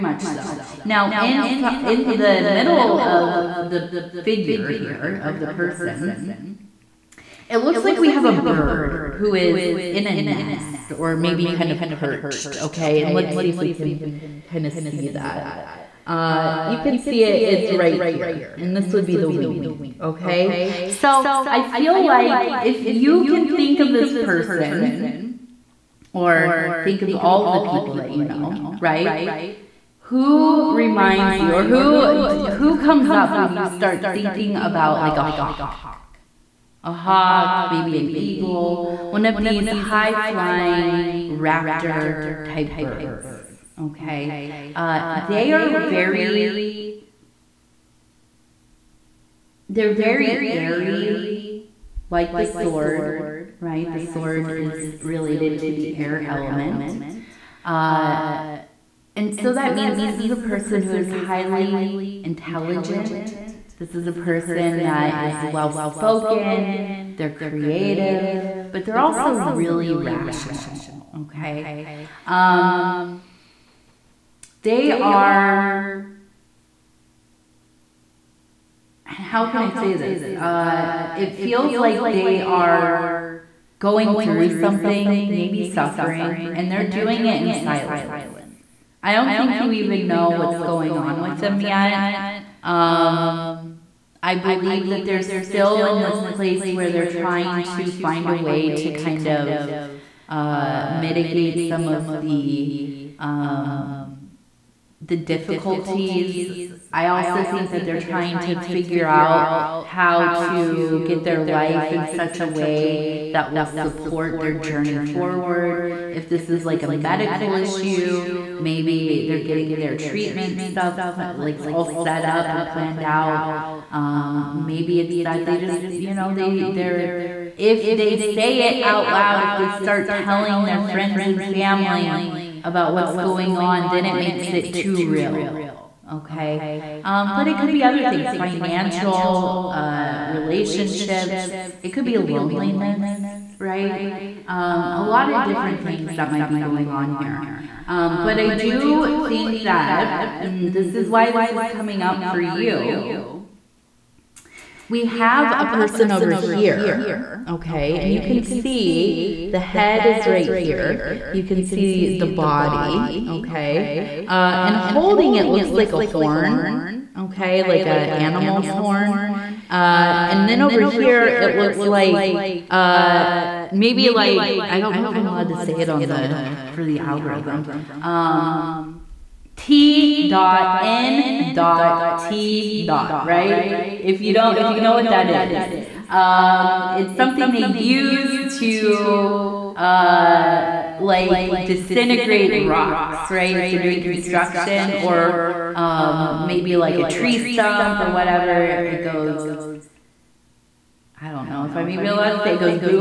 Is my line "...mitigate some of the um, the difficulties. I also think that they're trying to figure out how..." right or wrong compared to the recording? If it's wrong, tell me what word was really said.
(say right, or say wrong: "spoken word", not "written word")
right.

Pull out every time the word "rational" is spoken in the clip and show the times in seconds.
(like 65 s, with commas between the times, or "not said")
69 s.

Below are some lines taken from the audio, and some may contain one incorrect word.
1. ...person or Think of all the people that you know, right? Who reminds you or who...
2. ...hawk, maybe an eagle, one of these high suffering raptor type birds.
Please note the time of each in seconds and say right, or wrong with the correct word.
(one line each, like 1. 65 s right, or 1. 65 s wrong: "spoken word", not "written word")
1. 24 s right
2. 36 s wrong: "flying", not "suffering".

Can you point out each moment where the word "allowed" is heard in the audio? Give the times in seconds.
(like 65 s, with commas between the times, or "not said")
175 s, 202 s.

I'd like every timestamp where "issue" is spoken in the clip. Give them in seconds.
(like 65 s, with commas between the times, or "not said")
117 s.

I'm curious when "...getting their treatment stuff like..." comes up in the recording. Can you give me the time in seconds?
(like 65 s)
119 s.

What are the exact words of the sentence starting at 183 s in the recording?
If you don't, if you know what that is, um, it's something they use to, uh, like disintegrate rocks, right?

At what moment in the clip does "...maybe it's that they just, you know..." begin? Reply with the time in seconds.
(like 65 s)
124 s.